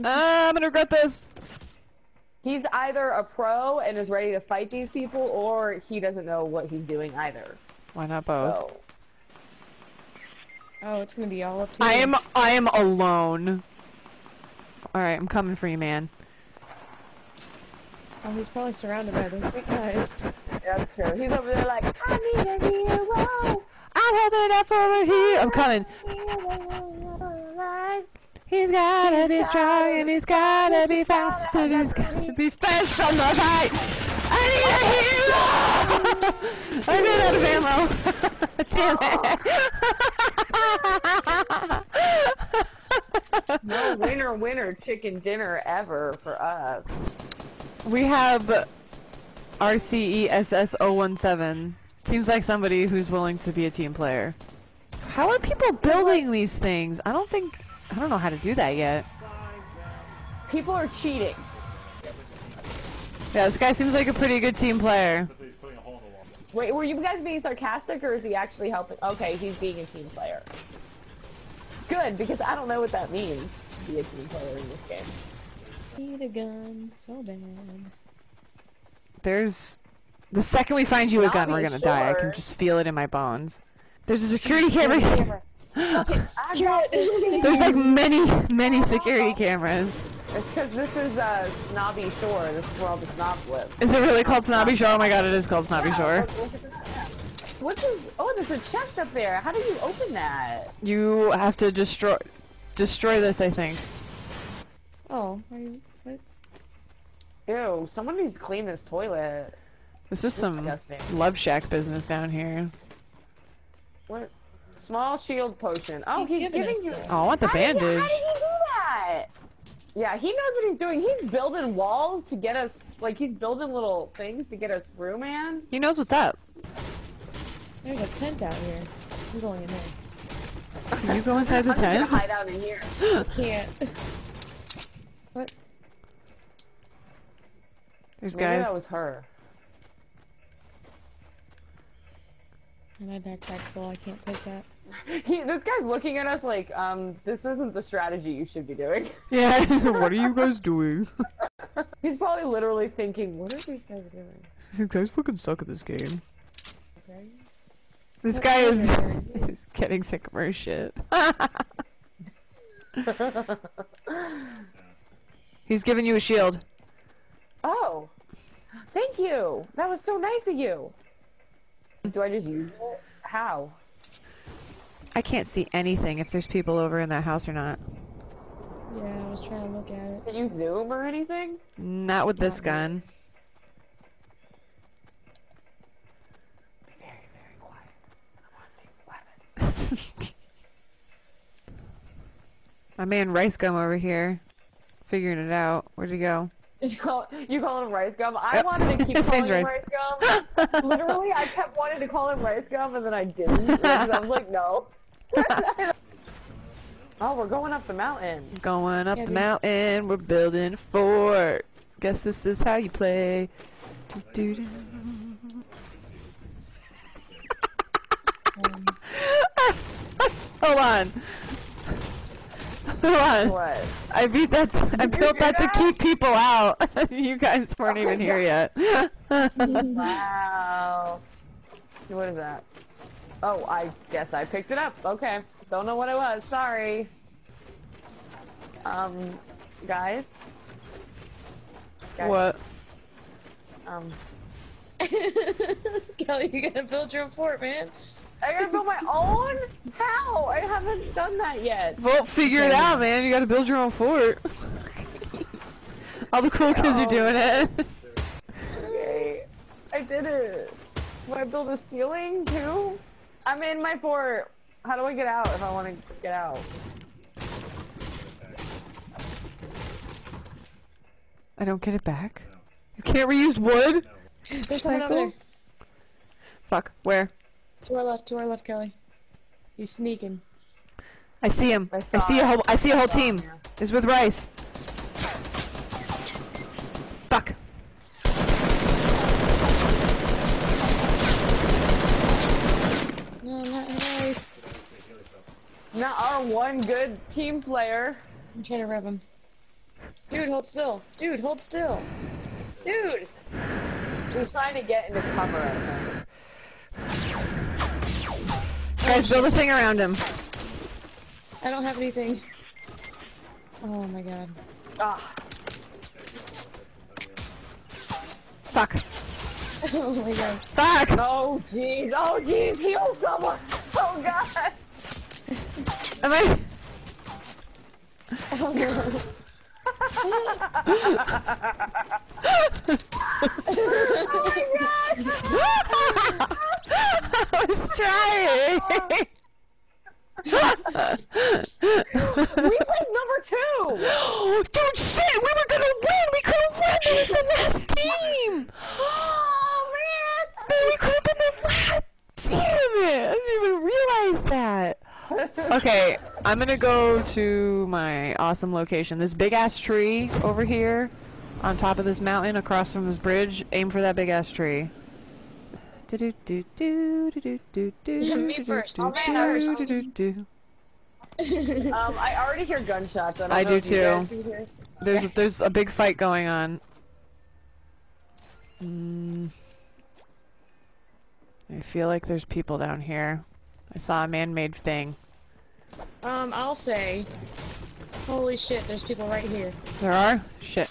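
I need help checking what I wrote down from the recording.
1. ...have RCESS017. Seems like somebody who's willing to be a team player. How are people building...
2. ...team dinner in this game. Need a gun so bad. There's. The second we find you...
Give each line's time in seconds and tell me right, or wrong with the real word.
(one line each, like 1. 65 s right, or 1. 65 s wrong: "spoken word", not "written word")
1. 48 s right
2. 74 s wrong: "player", not "dinner".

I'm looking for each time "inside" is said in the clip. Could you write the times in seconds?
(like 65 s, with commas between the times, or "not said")
131 s.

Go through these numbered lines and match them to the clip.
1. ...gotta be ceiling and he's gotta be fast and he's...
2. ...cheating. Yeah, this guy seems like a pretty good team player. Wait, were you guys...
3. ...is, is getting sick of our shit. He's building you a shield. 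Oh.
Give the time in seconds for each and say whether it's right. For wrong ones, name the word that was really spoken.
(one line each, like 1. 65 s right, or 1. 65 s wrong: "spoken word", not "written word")
1. 28 s wrong: "strong", not "ceiling"
2. 60 s right
3. 158 s wrong: "giving", not "building".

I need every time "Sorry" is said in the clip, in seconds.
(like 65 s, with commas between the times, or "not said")
236 s.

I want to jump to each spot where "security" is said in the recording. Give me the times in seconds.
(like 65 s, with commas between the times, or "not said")
84 s, 88 s.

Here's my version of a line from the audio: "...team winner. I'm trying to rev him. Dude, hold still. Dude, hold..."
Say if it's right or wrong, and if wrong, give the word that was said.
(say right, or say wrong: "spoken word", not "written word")
wrong: "player", not "winner".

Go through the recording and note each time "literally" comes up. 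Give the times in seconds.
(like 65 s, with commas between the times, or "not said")
152 s, 200 s.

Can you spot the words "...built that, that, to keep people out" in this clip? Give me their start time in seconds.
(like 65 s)
225 s.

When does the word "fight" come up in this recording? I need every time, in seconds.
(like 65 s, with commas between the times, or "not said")
4 s, 33 s, 375 s.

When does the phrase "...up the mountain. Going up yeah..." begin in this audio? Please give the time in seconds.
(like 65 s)
207 s.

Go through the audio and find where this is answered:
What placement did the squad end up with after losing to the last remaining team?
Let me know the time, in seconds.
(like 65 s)
342 s.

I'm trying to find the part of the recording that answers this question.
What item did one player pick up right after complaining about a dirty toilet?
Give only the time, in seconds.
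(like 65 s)
114 s.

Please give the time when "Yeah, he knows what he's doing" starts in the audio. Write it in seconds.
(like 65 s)
119 s.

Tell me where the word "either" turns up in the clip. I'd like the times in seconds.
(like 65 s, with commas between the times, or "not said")
2 s, 7 s.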